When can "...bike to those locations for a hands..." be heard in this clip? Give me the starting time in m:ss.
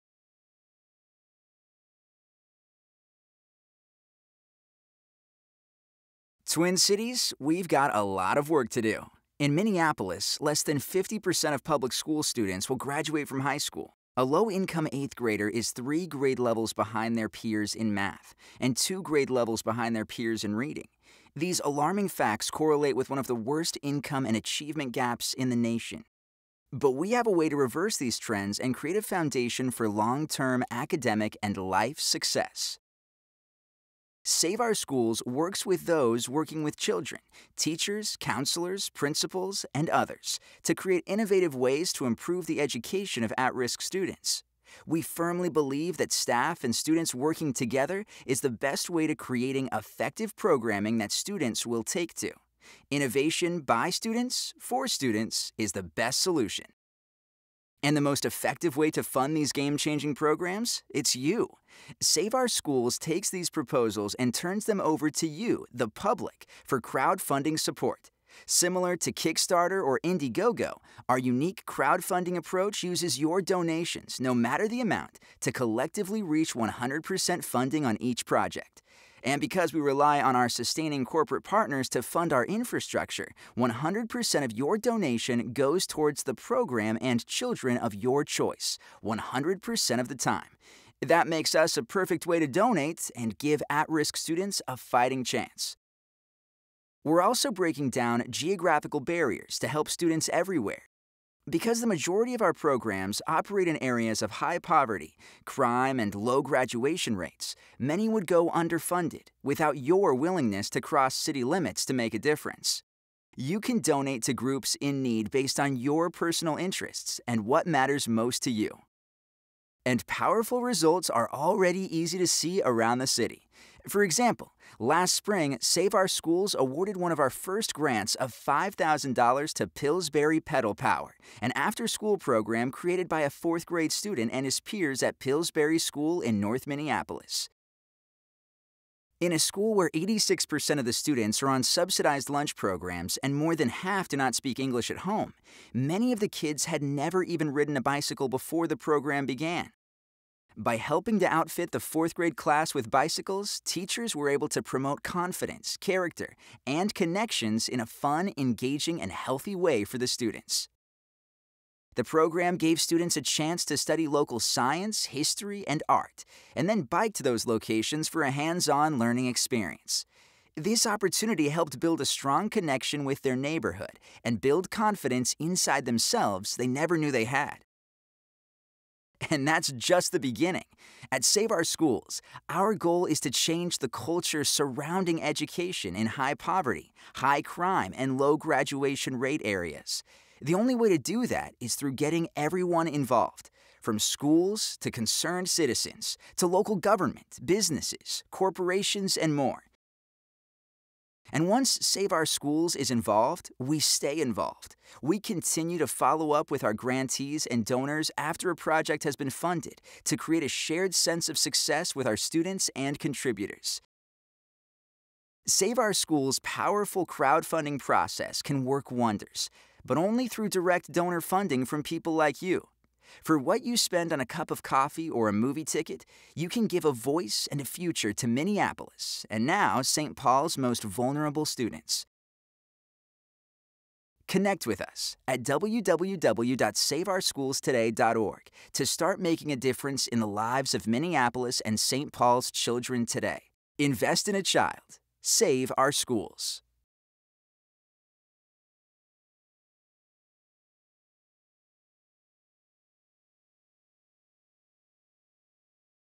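2:46.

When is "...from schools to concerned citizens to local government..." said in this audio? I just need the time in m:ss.
3:13.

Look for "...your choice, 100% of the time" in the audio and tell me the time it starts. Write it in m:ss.
1:27.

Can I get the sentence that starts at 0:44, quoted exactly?
We firmly believe that staff and students working together is the best way to creating effective programming that students will take to.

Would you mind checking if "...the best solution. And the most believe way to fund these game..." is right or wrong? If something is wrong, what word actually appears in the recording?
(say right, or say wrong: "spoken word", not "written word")
wrong: "effective", not "believe".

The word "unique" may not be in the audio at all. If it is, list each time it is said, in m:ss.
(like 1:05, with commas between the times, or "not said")
1:11.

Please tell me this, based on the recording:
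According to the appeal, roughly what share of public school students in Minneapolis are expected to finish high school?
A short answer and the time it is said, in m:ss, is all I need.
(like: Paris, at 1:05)
less than 50%, at 0:10.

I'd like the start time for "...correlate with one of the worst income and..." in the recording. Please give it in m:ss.
0:22.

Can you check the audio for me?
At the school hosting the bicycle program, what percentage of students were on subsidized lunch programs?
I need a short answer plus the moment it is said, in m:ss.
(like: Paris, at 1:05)
86%, at 2:19.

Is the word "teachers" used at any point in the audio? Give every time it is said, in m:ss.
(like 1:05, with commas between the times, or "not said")
0:37, 2:33.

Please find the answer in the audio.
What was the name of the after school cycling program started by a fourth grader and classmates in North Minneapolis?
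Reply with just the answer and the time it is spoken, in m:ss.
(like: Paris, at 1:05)
Pillsbury Pedal Power, at 2:09.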